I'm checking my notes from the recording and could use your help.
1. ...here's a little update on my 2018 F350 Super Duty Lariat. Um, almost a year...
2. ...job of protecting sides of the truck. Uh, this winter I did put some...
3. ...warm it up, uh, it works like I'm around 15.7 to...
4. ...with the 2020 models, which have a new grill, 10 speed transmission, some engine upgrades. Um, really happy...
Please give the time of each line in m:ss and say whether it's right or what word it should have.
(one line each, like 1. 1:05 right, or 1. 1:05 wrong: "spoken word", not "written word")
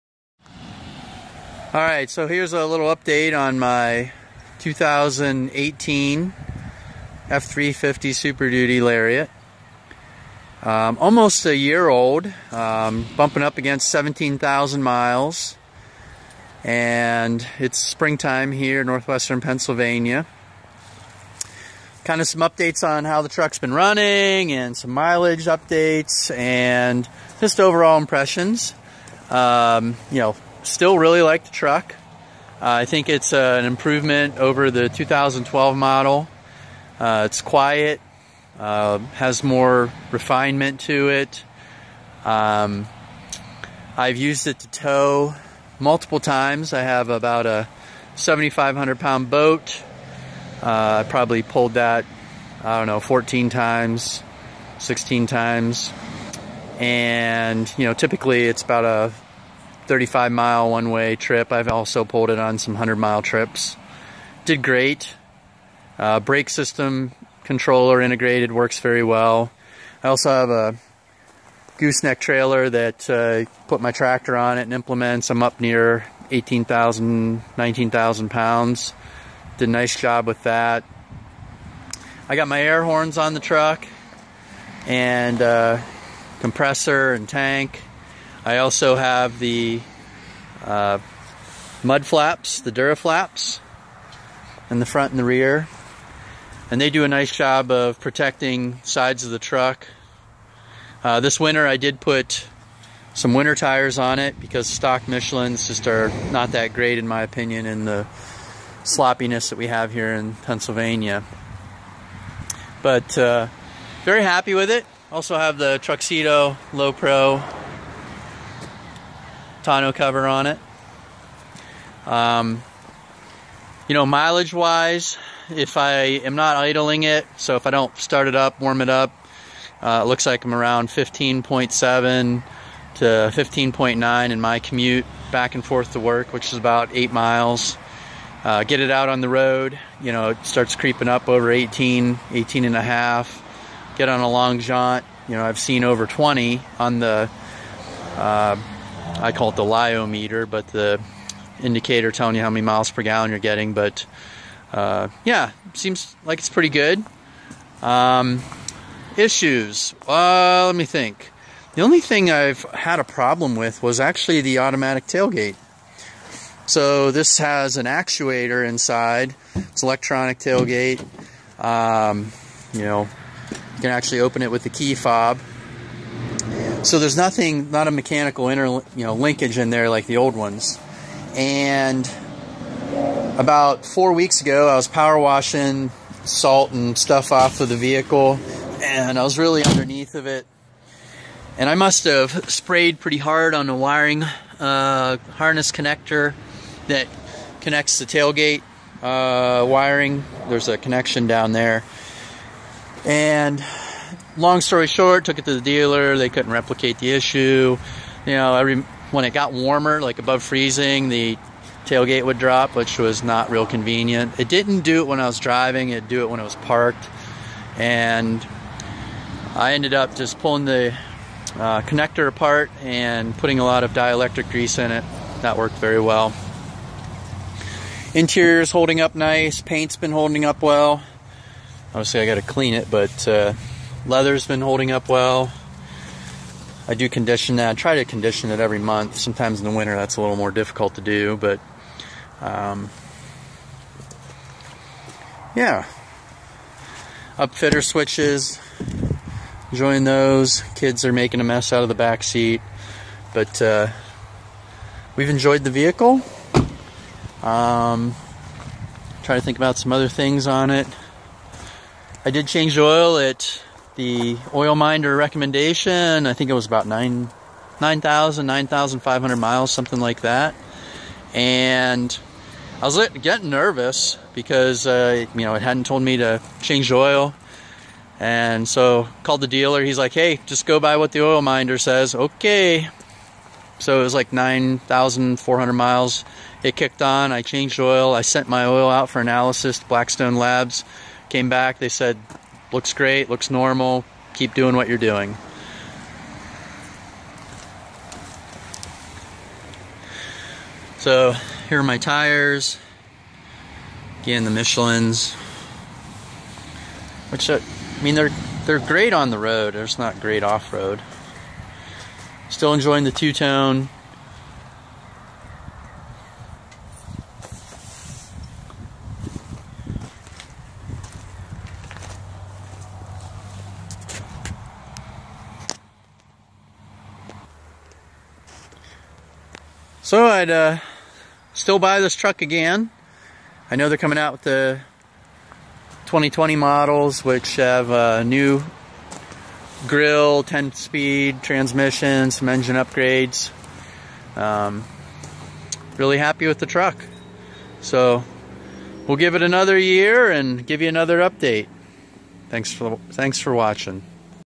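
1. 0:02 right
2. 1:37 right
3. 2:08 wrong: "looks", not "works"
4. 5:34 right.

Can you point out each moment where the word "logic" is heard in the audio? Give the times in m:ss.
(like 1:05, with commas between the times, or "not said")
not said.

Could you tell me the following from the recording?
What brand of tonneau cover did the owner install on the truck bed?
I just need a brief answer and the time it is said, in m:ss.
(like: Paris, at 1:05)
Truxedo Lo Pro, at 1:55.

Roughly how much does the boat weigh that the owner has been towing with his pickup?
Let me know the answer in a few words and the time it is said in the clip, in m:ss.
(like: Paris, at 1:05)
7,500 pounds, at 0:48.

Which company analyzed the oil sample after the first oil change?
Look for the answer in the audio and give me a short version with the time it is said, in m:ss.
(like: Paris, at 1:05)
Blackstone Labs, at 4:49.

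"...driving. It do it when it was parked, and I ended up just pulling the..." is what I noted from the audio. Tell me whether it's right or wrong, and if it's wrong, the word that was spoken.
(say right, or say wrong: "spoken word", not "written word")
right.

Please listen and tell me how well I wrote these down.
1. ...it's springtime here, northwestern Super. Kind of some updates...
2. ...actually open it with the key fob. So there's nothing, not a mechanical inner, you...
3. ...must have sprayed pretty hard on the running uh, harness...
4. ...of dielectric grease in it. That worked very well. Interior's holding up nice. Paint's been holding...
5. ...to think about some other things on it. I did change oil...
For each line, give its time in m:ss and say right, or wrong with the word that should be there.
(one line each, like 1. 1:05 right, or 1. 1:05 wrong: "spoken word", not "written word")
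1. 0:17 wrong: "Pennsylvania", not "Super"
2. 2:53 right
3. 3:11 wrong: "wiring", not "running"
4. 3:43 right
5. 4:19 right.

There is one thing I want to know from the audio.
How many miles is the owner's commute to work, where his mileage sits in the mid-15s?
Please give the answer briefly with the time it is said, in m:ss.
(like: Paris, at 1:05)
8 miles, at 2:16.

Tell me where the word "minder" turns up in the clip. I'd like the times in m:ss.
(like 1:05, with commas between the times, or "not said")
4:24, 4:41.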